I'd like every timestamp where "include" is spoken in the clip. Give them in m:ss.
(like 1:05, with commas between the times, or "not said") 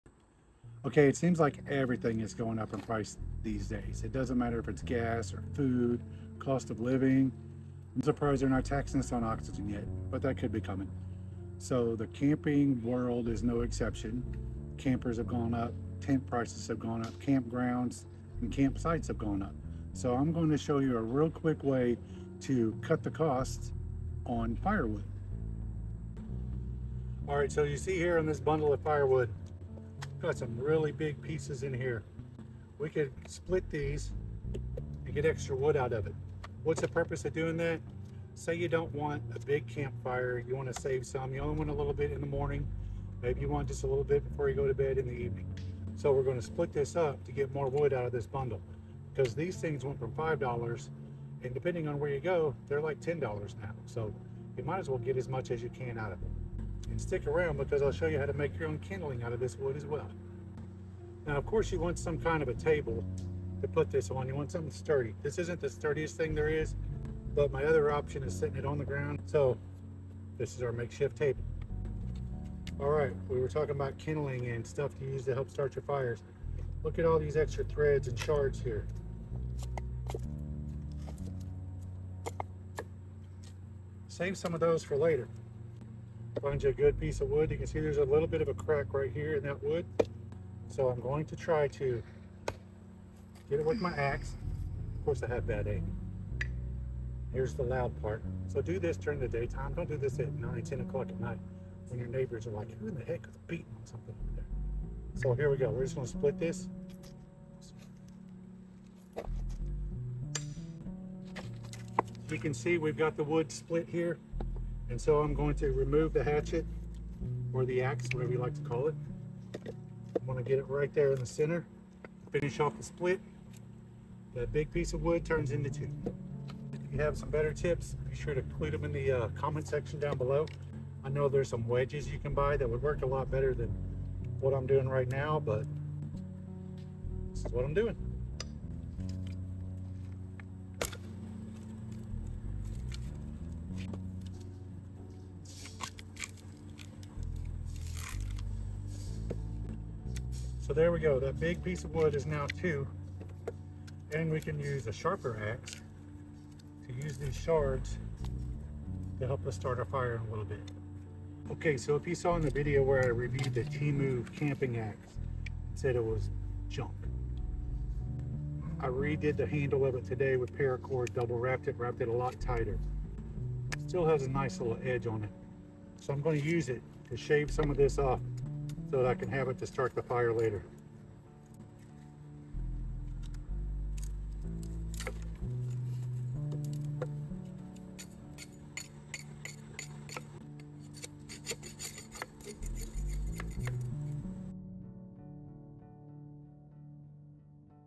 2:08.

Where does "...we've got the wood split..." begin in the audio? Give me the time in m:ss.
1:52.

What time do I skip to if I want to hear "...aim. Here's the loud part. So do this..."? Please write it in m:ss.
1:35.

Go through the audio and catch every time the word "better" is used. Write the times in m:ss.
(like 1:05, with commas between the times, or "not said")
2:07, 2:13.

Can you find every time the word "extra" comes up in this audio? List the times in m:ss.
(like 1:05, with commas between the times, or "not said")
0:35, 1:17.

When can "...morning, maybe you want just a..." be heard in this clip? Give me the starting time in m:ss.
0:42.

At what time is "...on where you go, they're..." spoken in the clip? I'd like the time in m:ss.
0:51.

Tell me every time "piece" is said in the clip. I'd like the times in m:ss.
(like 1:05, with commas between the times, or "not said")
0:31, 1:26, 2:04, 2:31.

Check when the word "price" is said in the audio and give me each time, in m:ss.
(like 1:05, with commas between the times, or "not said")
0:02, 0:16.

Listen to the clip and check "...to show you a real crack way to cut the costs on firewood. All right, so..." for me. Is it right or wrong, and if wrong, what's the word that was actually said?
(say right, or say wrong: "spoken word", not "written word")
wrong: "quick", not "crack".